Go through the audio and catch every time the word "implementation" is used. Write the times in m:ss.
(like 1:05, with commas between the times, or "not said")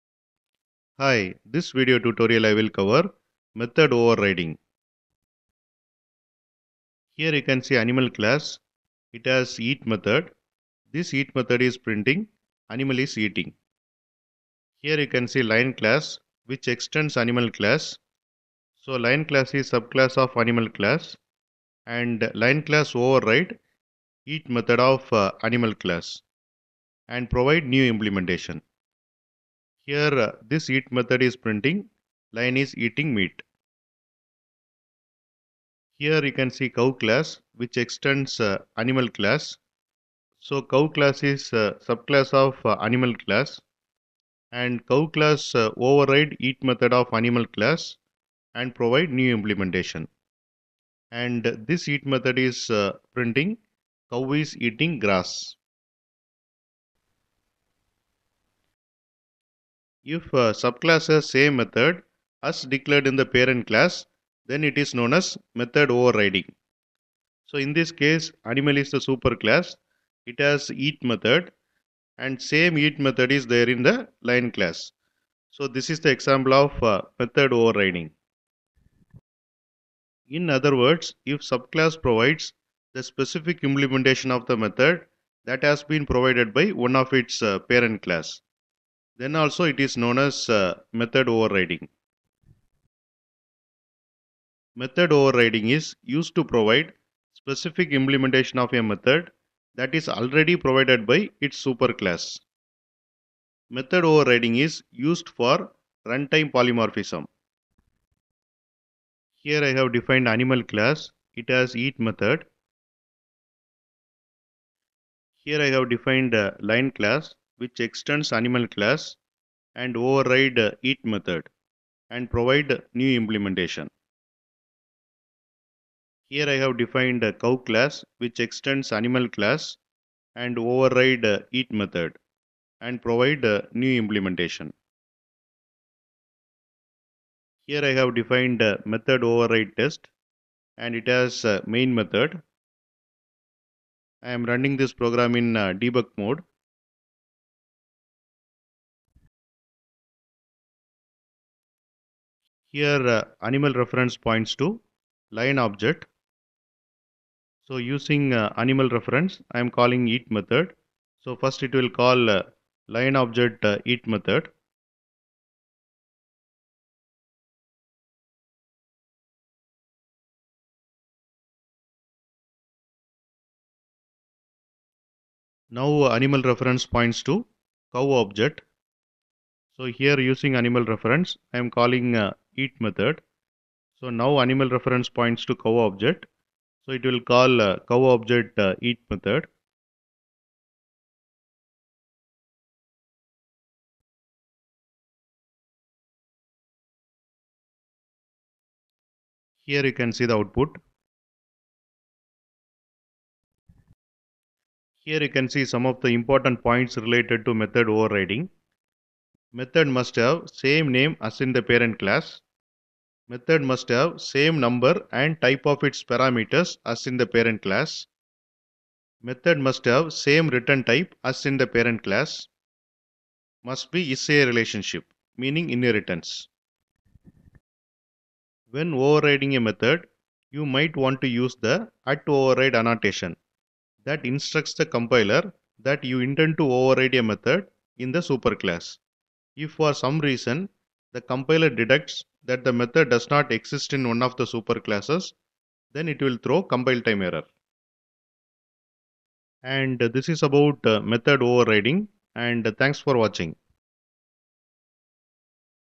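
0:27, 0:49, 1:23, 1:37, 2:03, 2:14.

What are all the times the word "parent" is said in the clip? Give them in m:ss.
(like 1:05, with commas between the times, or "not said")
1:03, 1:27, 3:31, 3:37, 3:41.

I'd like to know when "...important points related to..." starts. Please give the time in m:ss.
3:26.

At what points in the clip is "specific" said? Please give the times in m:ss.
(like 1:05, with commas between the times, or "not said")
1:23, 1:37.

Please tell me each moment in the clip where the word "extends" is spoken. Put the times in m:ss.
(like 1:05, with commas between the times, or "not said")
0:16, 0:37, 1:57, 2:08.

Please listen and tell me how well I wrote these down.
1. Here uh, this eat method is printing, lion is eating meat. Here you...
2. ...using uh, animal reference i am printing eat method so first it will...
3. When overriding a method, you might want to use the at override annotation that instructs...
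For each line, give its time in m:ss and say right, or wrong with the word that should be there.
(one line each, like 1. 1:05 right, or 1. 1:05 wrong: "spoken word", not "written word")
1. 0:29 right
2. 2:37 wrong: "calling", not "printing"
3. 3:48 right.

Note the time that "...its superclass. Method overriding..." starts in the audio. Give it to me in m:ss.
1:41.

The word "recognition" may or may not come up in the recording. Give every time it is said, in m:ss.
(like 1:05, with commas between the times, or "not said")
not said.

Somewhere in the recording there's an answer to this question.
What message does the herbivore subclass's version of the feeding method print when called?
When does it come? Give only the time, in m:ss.
0:54.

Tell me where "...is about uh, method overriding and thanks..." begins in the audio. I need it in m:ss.
4:10.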